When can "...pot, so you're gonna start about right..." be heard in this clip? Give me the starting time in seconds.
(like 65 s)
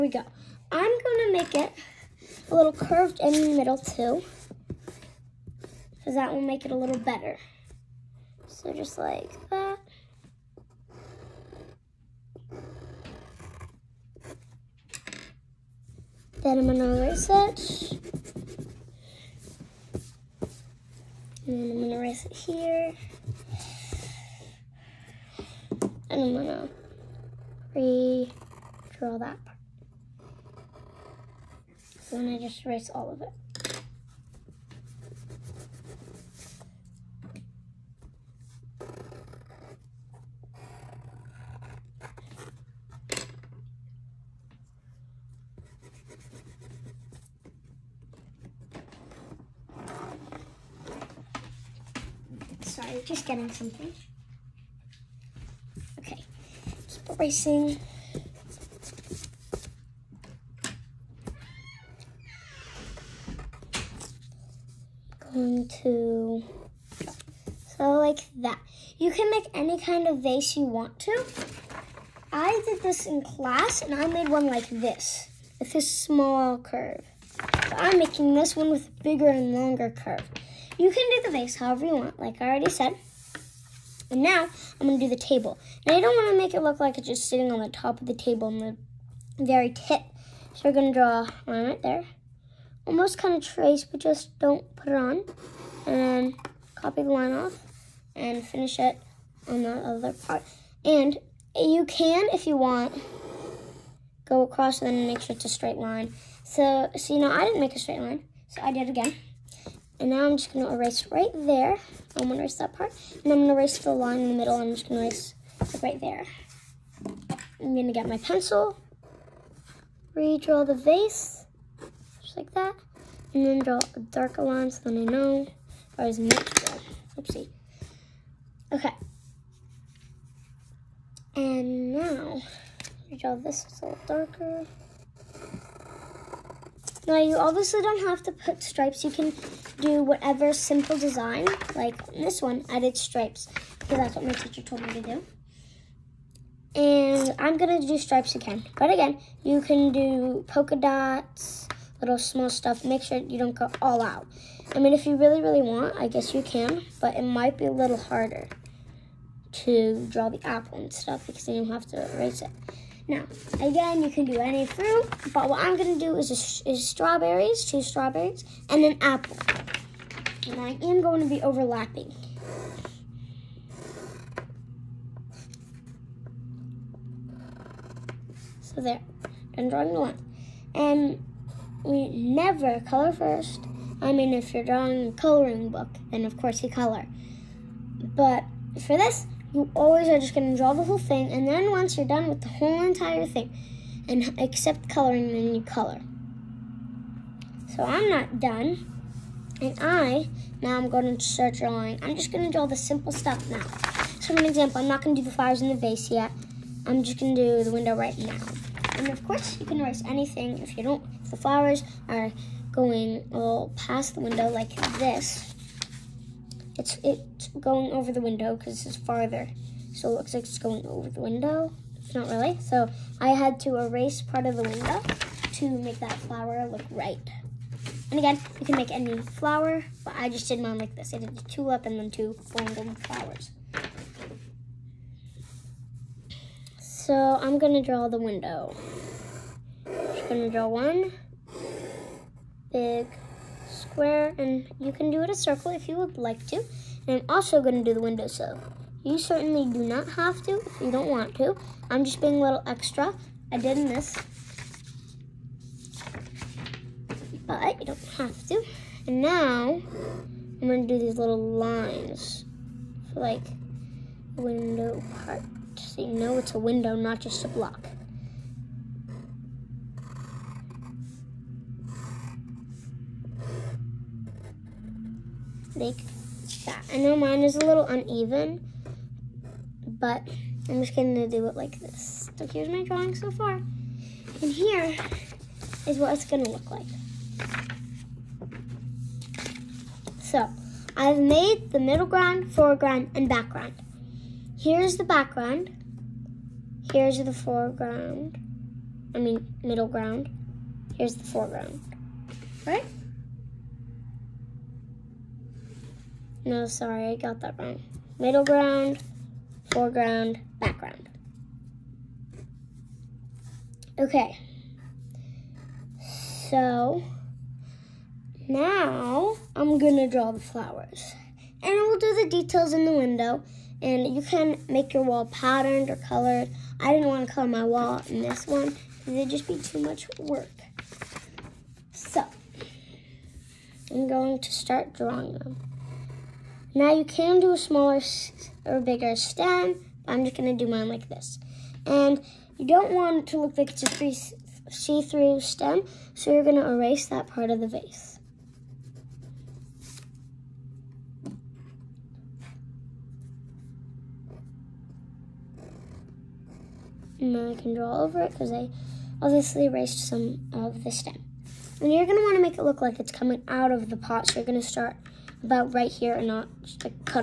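363 s.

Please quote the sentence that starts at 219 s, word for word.
So it looks like it's going over the window.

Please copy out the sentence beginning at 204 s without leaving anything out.
So for an example, I'm not going to do the flowers in the vase yet.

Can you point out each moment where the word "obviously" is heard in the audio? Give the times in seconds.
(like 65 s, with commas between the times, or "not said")
137 s, 359 s.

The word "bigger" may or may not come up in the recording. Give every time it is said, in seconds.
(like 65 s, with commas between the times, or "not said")
79 s, 338 s.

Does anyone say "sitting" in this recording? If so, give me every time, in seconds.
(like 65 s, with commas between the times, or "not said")
87 s.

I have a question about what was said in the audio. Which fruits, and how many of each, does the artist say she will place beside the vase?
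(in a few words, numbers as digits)
two strawberries and an apple.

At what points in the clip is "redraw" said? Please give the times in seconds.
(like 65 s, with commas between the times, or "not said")
27 s, 120 s, 133 s.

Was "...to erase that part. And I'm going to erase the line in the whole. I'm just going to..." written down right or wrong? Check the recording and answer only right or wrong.
wrong.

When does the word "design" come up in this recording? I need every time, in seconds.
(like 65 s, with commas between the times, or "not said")
140 s.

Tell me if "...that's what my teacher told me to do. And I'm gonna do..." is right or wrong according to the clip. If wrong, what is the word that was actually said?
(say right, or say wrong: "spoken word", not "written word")
right.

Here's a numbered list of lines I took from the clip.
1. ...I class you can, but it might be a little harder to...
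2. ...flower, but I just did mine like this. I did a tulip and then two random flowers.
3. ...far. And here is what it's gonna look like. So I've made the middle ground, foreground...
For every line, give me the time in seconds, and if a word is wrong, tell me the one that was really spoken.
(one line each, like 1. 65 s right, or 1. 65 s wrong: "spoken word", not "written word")
1. 155 s wrong: "guess", not "class"
2. 229 s right
3. 283 s right.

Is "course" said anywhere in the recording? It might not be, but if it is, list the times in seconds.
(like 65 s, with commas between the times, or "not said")
186 s, 209 s.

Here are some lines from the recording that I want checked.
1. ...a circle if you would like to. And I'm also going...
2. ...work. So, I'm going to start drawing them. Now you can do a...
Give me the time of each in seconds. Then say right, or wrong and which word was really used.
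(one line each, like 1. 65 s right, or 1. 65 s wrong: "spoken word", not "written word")
1. 245 s right
2. 330 s right.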